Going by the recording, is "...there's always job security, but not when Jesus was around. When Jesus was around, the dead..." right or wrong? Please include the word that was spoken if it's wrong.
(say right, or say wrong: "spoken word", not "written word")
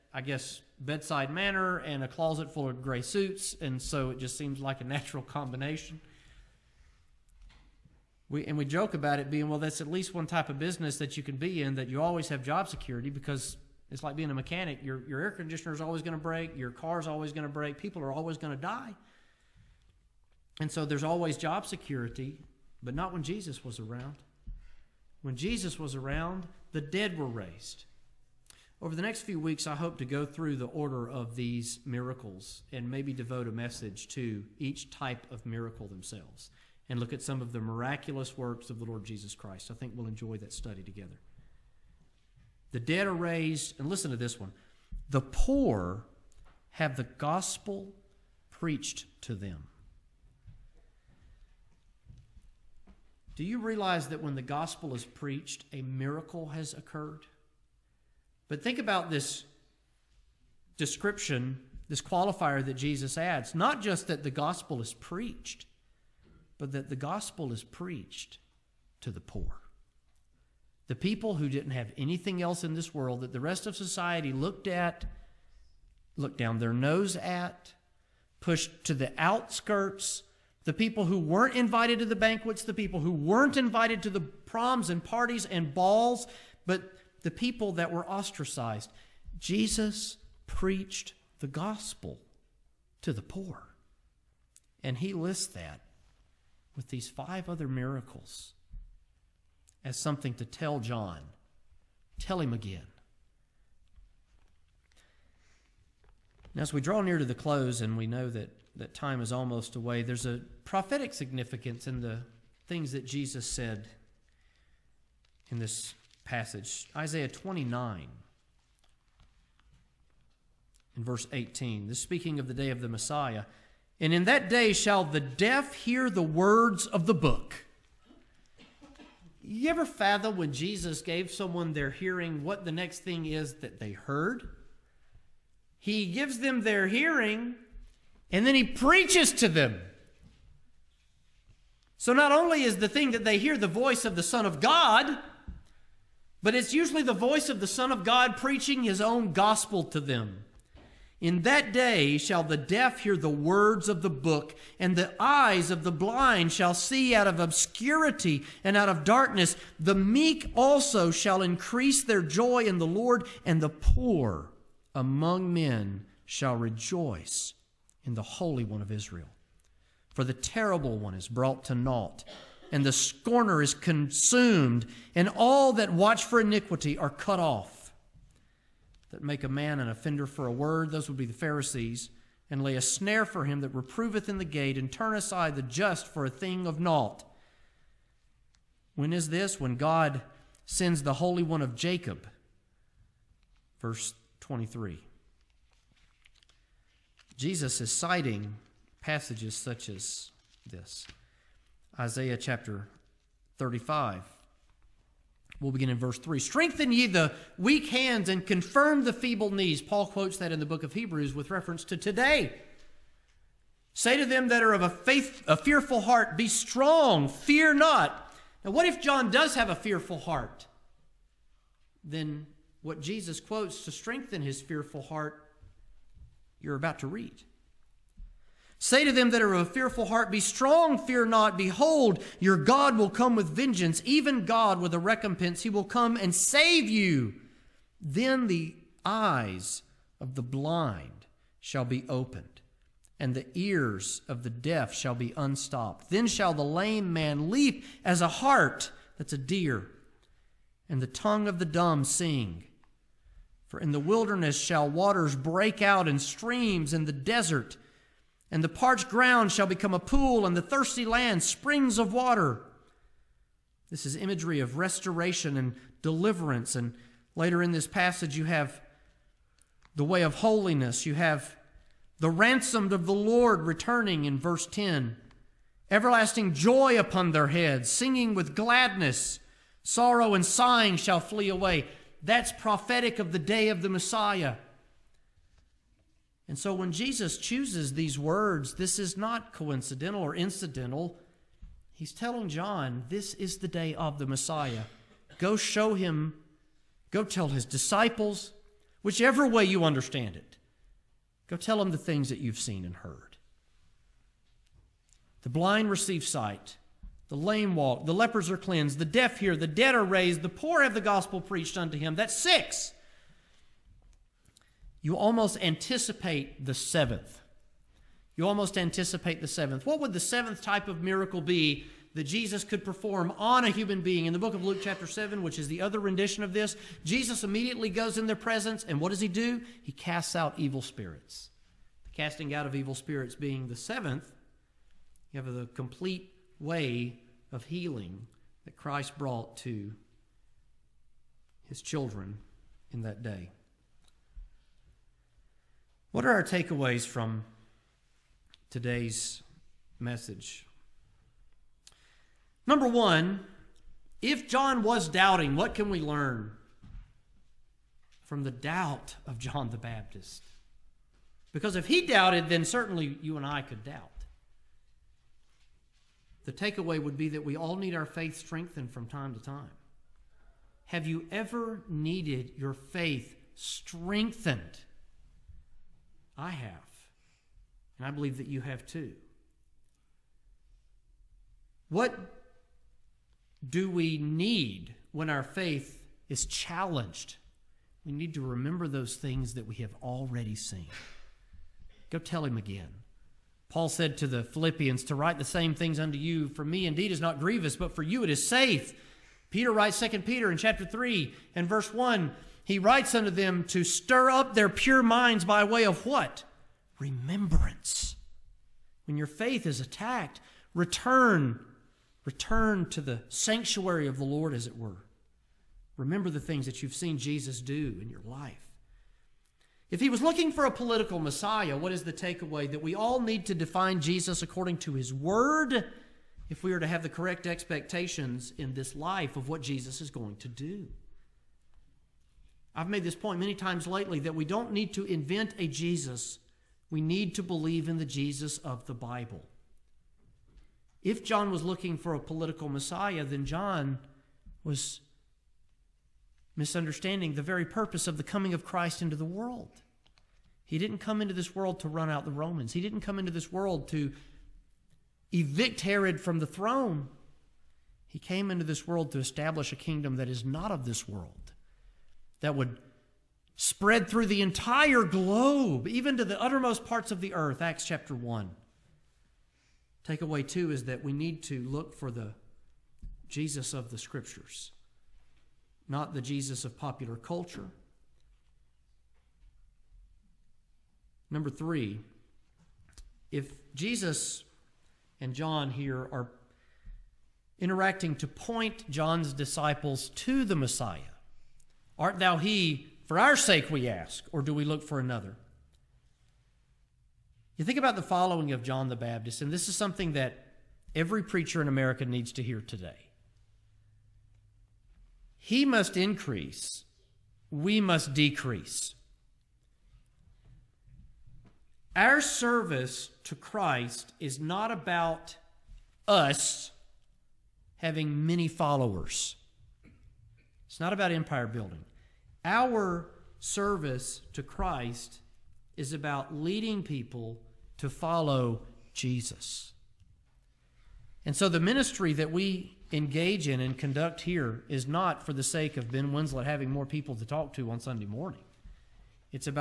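right.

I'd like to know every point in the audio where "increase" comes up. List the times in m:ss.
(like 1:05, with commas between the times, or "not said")
2:41, 8:25.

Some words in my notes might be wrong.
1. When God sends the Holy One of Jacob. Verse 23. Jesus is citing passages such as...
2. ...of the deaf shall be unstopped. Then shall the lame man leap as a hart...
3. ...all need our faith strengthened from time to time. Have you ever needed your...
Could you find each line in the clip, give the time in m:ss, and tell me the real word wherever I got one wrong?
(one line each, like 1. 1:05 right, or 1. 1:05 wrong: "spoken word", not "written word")
1. 3:09 right
2. 4:04 right
3. 6:07 right.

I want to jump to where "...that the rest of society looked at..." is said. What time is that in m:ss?
1:13.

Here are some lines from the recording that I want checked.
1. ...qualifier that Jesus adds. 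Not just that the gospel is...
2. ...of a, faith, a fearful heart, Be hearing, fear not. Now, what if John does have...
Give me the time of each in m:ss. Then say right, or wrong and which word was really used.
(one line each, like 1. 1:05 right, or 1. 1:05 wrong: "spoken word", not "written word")
1. 1:02 right
2. 3:34 wrong: "strong", not "hearing".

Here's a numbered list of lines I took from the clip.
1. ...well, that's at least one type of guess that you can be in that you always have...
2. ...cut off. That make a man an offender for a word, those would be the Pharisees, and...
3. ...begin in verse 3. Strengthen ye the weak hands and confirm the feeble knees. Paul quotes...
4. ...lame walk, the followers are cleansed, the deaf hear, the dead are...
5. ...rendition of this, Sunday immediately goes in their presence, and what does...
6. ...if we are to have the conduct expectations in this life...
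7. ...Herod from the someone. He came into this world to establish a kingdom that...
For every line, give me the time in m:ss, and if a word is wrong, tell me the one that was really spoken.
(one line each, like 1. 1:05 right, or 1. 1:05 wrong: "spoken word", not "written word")
1. 0:09 wrong: "business", not "guess"
2. 2:57 right
3. 3:25 right
4. 5:07 wrong: "lepers", not "followers"
5. 5:25 wrong: "Jesus", not "Sunday"
6. 7:06 wrong: "correct", not "conduct"
7. 7:35 wrong: "throne", not "someone".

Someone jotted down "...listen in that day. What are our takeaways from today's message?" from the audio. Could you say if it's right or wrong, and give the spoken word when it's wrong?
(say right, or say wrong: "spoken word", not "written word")
wrong: "children", not "listen".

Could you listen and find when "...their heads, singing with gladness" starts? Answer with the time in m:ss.
4:37.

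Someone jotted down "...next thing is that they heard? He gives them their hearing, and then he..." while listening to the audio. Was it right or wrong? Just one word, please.
right.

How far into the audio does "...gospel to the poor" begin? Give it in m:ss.
1:31.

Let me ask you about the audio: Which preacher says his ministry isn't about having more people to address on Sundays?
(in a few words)
Ben Winslett.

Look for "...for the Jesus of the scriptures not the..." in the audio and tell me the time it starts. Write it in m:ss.
7:51.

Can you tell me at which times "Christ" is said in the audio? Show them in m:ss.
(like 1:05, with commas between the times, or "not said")
0:39, 5:38, 7:28, 8:33, 8:44.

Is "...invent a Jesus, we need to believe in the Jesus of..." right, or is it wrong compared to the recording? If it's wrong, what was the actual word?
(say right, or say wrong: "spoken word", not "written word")
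right.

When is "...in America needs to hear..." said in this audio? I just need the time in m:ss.
8:21.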